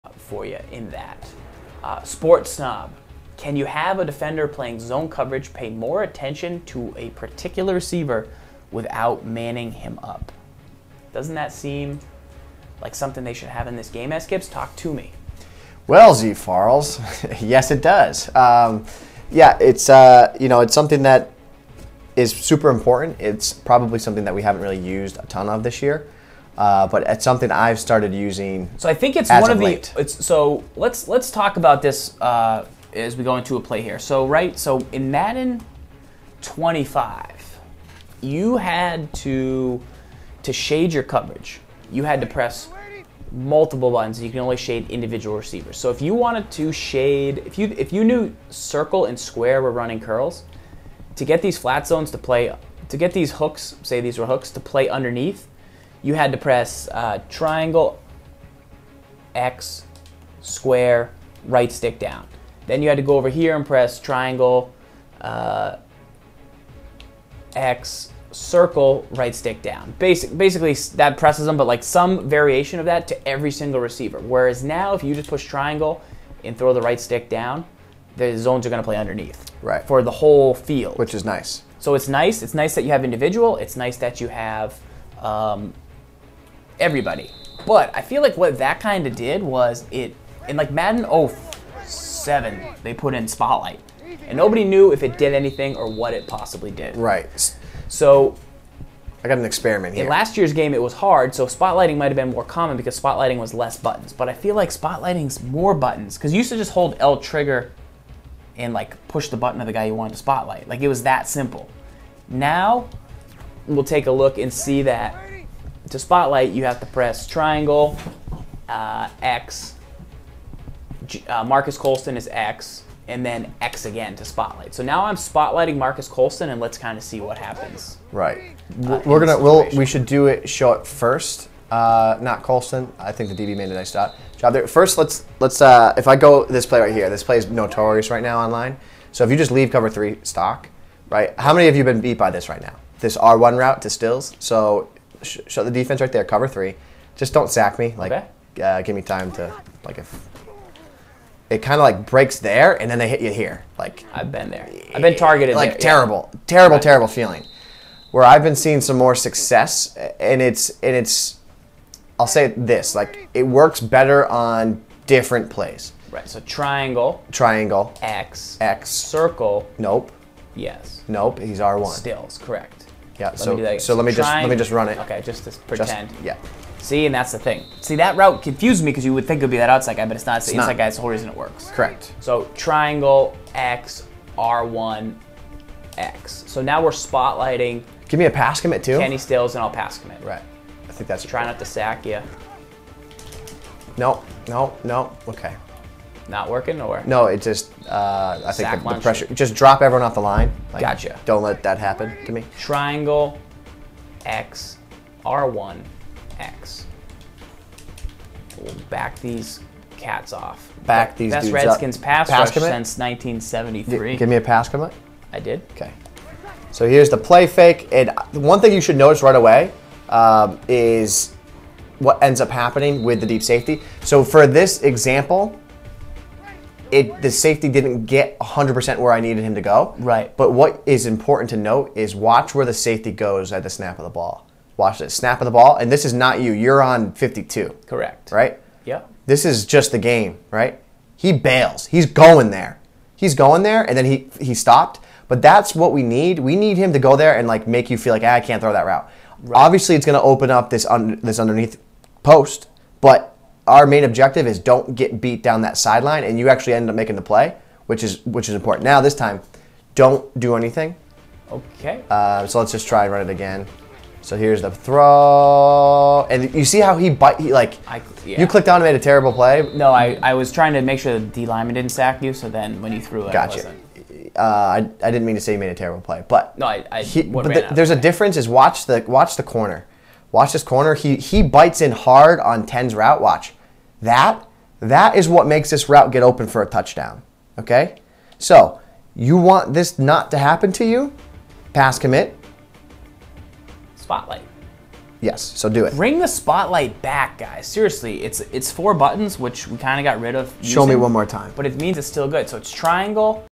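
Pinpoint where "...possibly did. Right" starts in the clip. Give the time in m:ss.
1:36.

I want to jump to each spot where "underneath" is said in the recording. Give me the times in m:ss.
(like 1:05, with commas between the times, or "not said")
0:54, 1:18, 4:11.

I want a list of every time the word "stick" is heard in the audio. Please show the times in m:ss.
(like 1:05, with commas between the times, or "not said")
1:01, 1:09, 1:16.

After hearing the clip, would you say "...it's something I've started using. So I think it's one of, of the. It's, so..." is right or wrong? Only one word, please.
right.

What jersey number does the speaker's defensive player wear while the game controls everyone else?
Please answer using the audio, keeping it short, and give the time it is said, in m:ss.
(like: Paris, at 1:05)
52, at 3:57.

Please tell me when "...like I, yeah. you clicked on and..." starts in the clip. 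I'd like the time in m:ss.
4:27.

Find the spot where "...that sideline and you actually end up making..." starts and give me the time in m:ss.
4:15.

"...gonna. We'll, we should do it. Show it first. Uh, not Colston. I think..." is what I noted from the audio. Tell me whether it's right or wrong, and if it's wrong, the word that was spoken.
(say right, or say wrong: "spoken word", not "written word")
right.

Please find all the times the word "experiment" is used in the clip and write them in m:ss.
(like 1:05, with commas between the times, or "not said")
1:39.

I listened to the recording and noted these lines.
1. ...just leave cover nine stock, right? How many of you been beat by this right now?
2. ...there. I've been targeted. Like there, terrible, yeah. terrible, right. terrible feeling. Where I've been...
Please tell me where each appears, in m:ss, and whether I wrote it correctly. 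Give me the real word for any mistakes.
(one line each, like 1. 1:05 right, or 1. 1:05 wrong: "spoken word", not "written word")
1. 2:19 wrong: "three", not "nine"
2. 2:34 right.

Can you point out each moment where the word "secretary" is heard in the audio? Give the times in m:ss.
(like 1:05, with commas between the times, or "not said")
not said.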